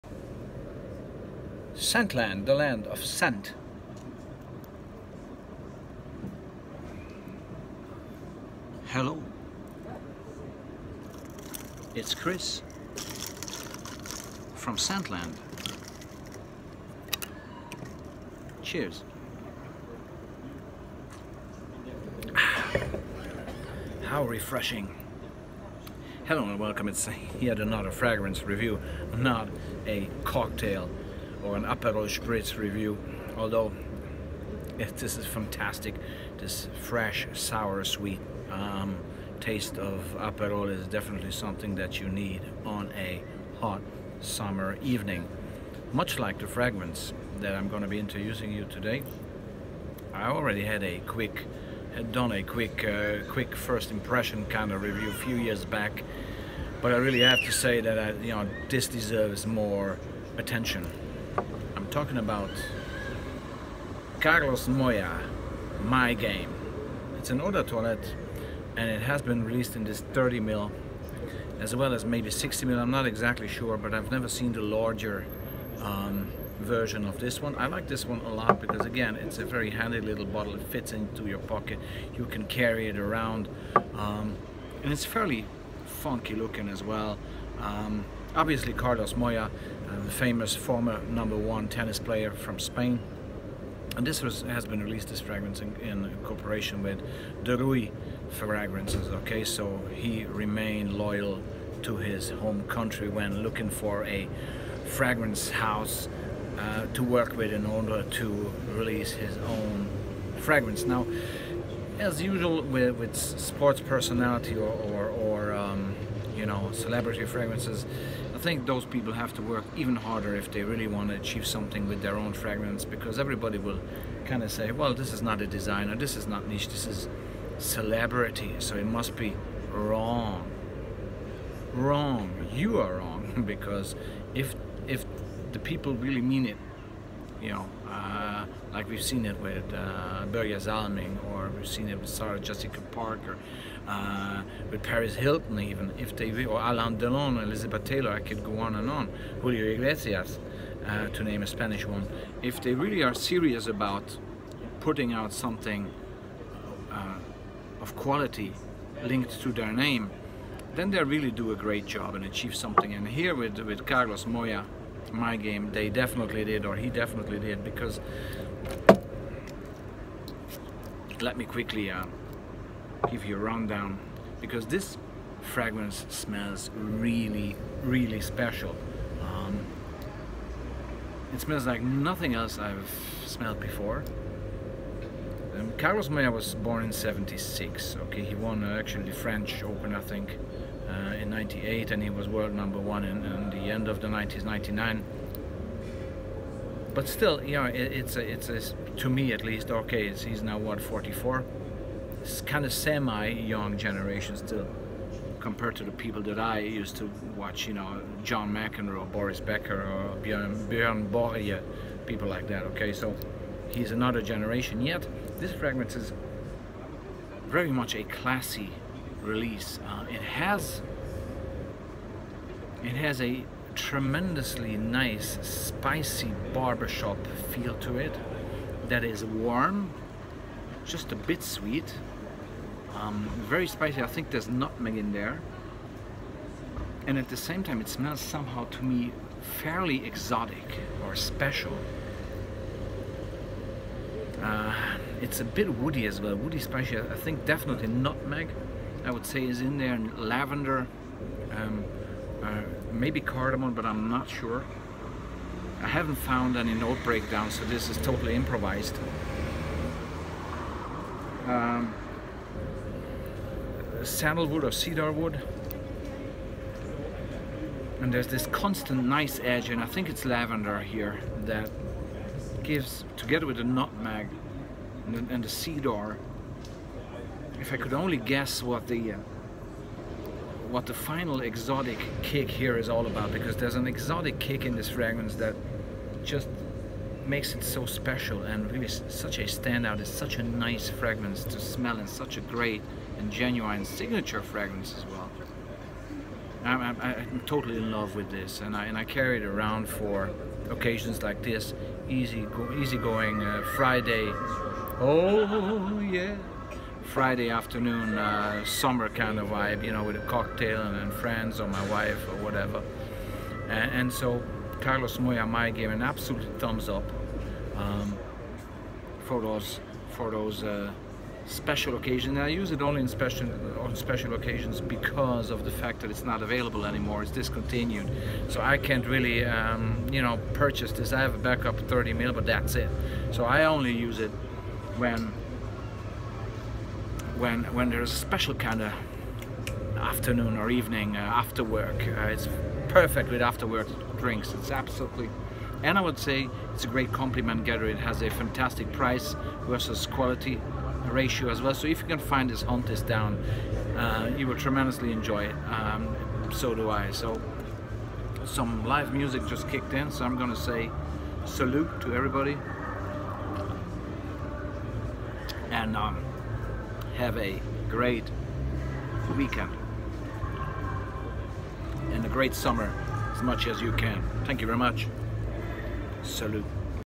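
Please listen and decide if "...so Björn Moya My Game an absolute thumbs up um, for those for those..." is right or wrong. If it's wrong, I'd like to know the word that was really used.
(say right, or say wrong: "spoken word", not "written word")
wrong: "Carlos", not "Björn".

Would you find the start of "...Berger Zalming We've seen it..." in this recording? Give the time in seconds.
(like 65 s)
140 s.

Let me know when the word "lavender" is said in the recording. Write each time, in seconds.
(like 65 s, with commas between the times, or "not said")
250 s, 270 s.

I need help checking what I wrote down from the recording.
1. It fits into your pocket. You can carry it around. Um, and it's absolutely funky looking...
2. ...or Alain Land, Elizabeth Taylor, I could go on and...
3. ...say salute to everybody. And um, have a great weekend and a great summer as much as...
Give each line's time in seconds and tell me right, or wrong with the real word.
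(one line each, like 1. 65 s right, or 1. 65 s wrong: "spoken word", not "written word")
1. 80 s wrong: "fairly", not "absolutely"
2. 146 s wrong: "Delon", not "Land"
3. 360 s right.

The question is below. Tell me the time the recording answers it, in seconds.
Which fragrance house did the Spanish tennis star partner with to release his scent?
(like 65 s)
97 s.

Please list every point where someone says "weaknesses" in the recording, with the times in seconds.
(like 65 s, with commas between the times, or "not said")
not said.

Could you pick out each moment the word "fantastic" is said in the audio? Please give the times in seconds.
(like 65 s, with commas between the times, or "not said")
35 s, 348 s.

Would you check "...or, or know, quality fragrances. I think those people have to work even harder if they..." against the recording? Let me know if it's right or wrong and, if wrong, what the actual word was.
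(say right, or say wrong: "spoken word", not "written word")
wrong: "celebrity", not "quality".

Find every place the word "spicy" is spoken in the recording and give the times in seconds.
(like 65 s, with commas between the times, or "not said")
225 s, 233 s, 246 s.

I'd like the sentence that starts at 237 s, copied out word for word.
And at the same time, it smells somehow to me fairly exotic or special.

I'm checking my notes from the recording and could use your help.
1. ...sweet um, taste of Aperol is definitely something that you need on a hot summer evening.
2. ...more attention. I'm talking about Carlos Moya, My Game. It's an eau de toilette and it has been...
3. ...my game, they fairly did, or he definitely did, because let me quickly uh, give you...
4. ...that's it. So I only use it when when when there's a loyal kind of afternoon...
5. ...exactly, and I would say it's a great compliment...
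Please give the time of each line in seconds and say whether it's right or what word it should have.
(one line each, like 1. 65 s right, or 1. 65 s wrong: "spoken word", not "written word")
1. 37 s right
2. 59 s right
3. 165 s wrong: "definitely", not "fairly"
4. 332 s wrong: "special", not "loyal"
5. 344 s wrong: "absolutely", not "exactly".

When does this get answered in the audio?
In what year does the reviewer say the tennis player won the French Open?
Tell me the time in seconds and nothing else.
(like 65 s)
191 s.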